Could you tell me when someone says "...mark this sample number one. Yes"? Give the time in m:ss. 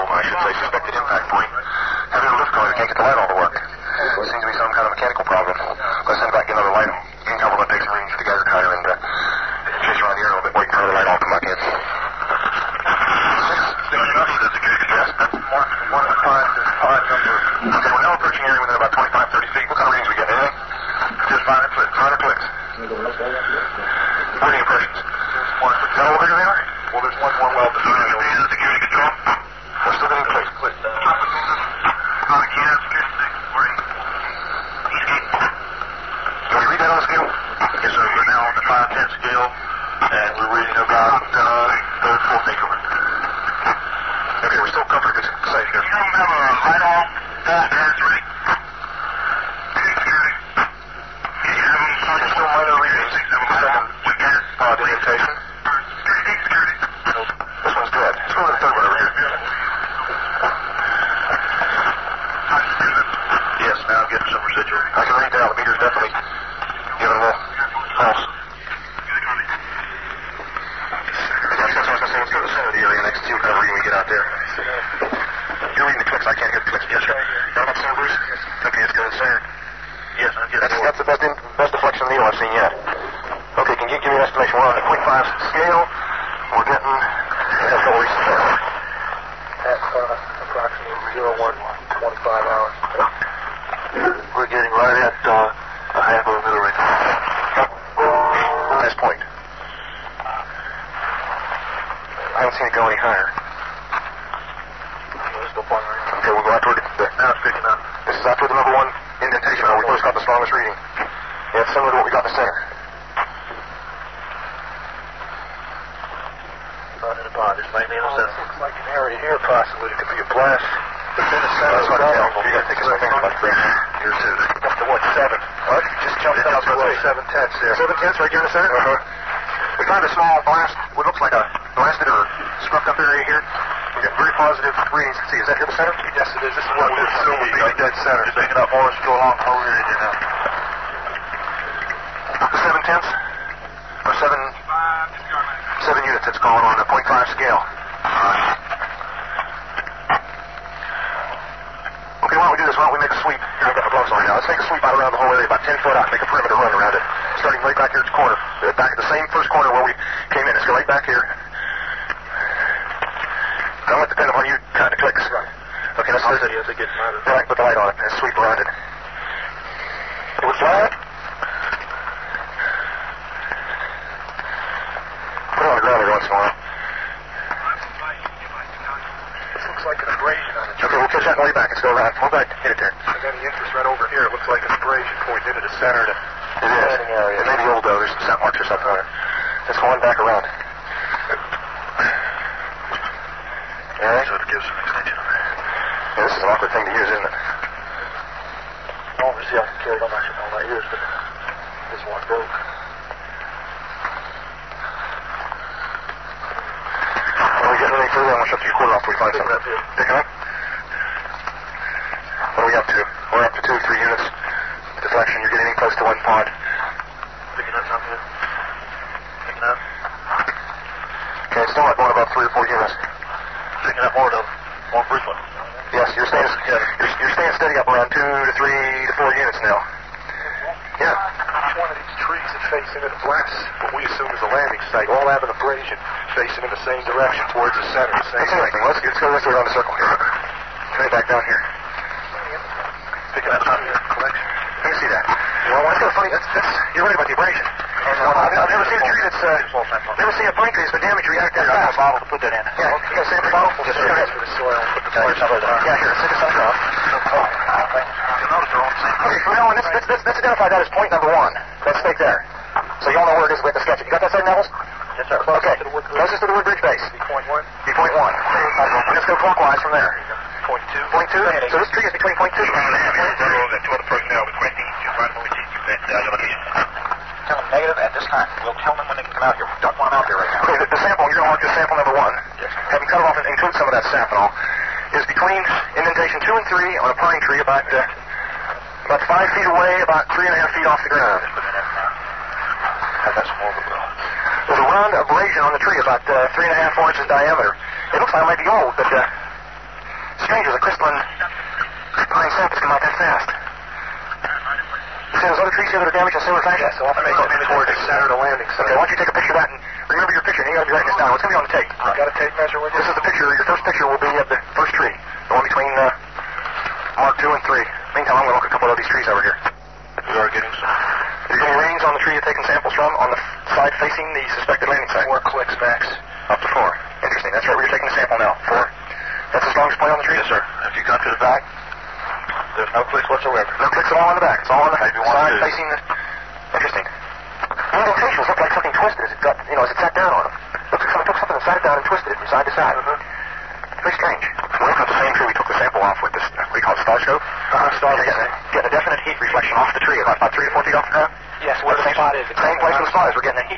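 4:41.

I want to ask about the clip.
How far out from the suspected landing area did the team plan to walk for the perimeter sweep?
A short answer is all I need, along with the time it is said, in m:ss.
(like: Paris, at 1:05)
10 feet, at 2:35.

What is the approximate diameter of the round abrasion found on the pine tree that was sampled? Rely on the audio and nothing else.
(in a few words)
3.5 to 4 inches.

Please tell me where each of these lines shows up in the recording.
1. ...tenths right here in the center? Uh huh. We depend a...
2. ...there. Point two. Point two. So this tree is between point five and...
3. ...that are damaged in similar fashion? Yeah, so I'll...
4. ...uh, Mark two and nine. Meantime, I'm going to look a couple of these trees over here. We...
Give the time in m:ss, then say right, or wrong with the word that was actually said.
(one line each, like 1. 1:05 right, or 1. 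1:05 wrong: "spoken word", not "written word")
1. 2:07 wrong: "found", not "depend"
2. 4:29 wrong: "two", not "five"
3. 5:05 right
4. 5:16 wrong: "three", not "nine".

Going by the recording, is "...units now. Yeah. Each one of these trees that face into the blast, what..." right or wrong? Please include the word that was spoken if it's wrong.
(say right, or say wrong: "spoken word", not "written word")
right.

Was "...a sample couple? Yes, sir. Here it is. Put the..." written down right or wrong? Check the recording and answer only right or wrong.
wrong.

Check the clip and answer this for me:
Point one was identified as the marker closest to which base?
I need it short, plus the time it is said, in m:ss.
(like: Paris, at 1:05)
Woodbridge, at 4:26.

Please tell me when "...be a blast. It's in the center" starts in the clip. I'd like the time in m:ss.
2:00.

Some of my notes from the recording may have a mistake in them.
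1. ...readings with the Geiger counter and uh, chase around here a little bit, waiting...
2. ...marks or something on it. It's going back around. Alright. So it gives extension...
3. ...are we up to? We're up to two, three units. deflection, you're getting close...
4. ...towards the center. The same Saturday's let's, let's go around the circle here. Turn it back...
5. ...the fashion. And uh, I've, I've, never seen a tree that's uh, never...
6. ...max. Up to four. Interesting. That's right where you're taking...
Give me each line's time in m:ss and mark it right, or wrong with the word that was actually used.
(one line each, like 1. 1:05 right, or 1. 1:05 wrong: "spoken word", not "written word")
1. 0:07 right
2. 3:08 right
3. 3:32 right
4. 3:57 wrong: "That", not "Saturday"
5. 4:07 wrong: "abrasion", not "fashion"
6. 5:25 right.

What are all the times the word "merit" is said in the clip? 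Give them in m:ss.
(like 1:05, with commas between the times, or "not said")
not said.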